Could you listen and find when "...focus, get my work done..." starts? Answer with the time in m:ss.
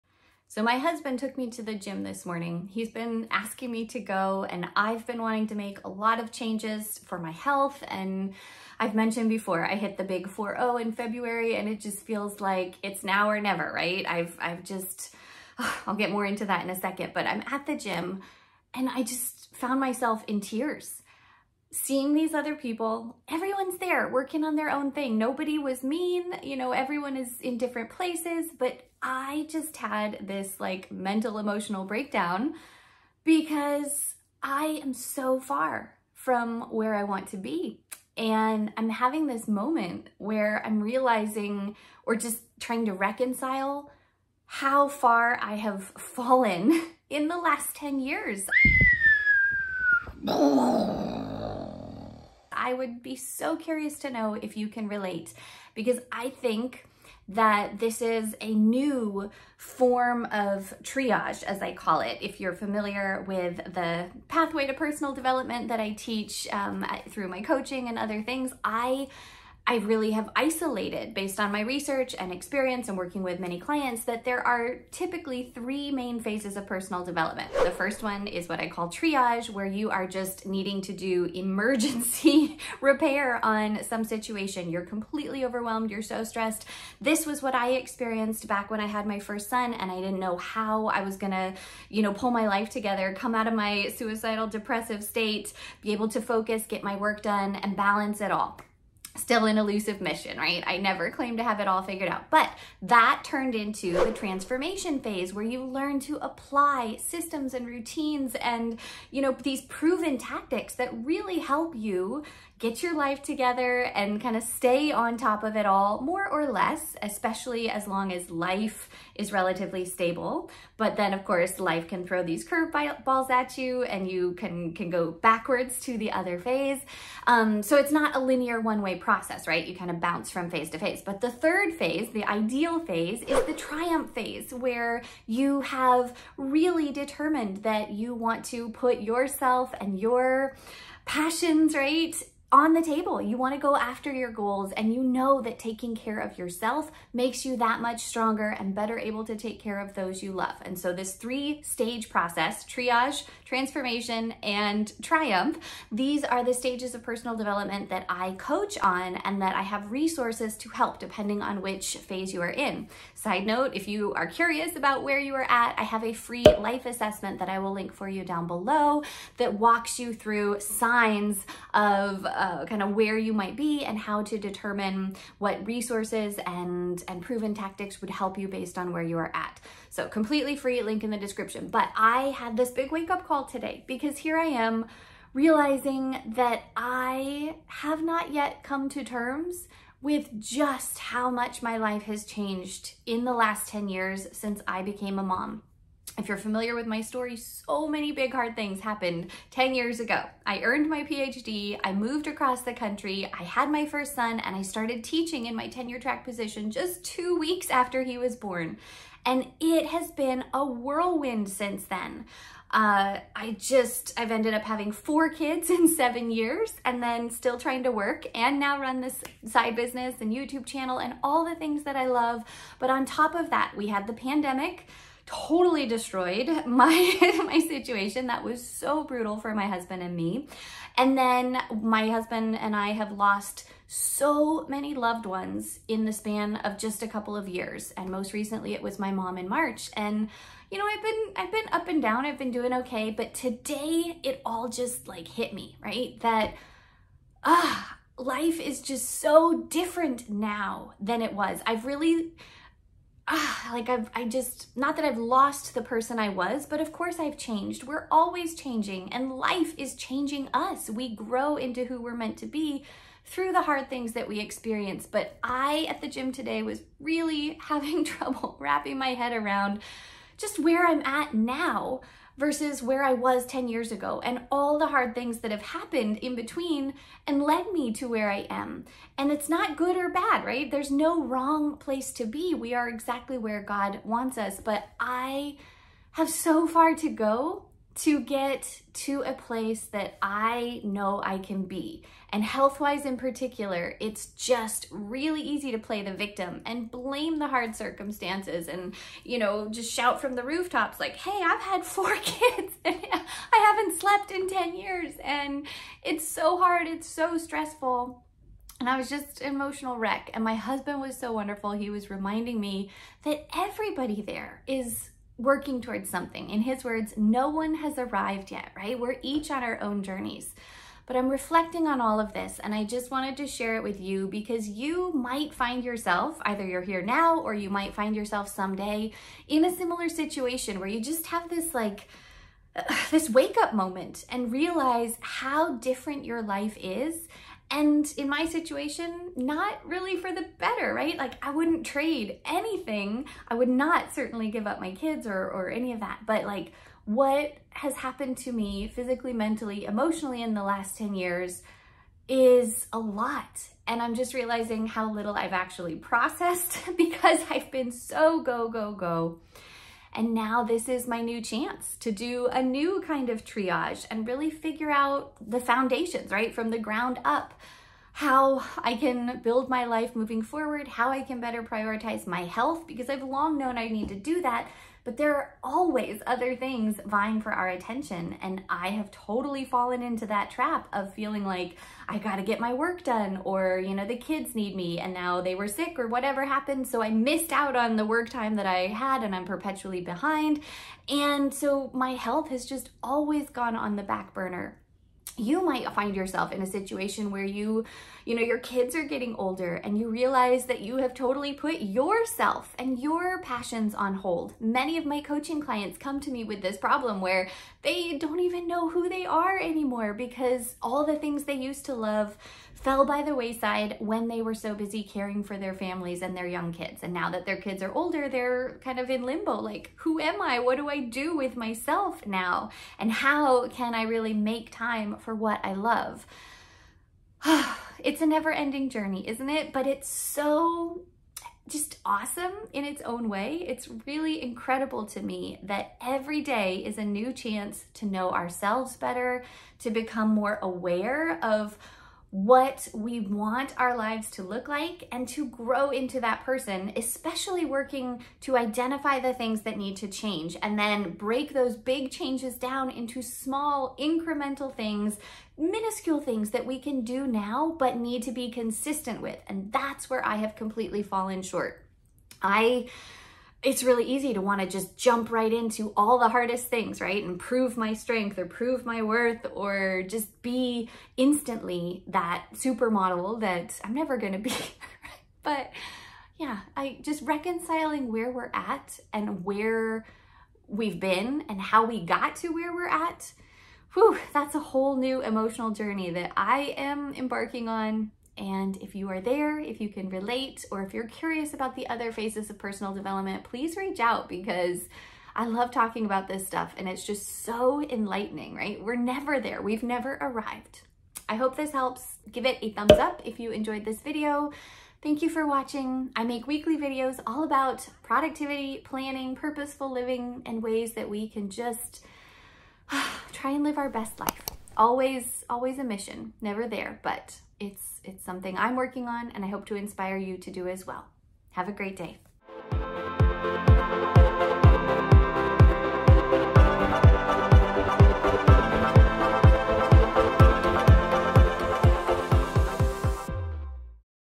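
1:36.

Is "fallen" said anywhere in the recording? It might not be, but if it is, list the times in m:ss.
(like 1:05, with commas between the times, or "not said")
0:45, 6:19, 7:41.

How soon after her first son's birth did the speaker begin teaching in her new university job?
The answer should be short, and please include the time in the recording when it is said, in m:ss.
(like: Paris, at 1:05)
2 weeks, at 3:27.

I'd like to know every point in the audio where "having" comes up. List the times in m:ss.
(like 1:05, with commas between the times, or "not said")
0:38, 3:34, 4:27.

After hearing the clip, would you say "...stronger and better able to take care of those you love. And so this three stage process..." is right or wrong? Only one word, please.
right.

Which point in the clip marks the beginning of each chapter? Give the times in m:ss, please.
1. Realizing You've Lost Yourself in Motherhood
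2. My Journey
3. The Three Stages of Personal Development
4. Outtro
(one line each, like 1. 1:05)
1. 6:40
2. 3:01
3. 0:56
4. 8:20.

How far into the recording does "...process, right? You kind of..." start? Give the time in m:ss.
2:08.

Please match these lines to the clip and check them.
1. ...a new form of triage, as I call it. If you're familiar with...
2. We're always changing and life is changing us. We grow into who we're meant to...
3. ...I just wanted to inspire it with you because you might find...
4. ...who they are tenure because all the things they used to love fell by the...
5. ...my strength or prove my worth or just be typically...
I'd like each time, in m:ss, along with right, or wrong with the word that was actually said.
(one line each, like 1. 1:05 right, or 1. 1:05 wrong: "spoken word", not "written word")
1. 0:58 right
2. 4:17 right
3. 5:22 wrong: "share", not "inspire"
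4. 6:48 wrong: "anymore", not "tenure"
5. 7:47 wrong: "instantly", not "typically".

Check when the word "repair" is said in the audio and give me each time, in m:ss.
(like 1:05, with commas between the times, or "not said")
1:22.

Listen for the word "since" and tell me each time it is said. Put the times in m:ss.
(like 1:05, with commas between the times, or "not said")
3:14, 3:31.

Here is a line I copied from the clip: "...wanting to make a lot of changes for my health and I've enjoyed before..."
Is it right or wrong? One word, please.
wrong.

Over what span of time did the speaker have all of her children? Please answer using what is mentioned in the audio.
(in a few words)
7 years.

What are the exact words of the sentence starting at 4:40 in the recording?
There's no wrong place to be.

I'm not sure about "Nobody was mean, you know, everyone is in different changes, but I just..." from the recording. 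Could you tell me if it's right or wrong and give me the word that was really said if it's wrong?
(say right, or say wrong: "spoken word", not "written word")
wrong: "places", not "changes".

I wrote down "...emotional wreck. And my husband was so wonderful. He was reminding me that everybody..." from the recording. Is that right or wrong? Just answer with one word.
right.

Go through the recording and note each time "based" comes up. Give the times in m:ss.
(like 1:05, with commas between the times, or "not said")
1:11, 2:58.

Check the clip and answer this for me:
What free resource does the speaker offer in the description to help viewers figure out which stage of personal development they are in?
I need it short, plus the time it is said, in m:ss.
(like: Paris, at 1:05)
life assessment, at 2:46.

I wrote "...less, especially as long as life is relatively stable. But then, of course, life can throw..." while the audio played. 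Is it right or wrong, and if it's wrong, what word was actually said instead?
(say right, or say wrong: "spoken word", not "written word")
right.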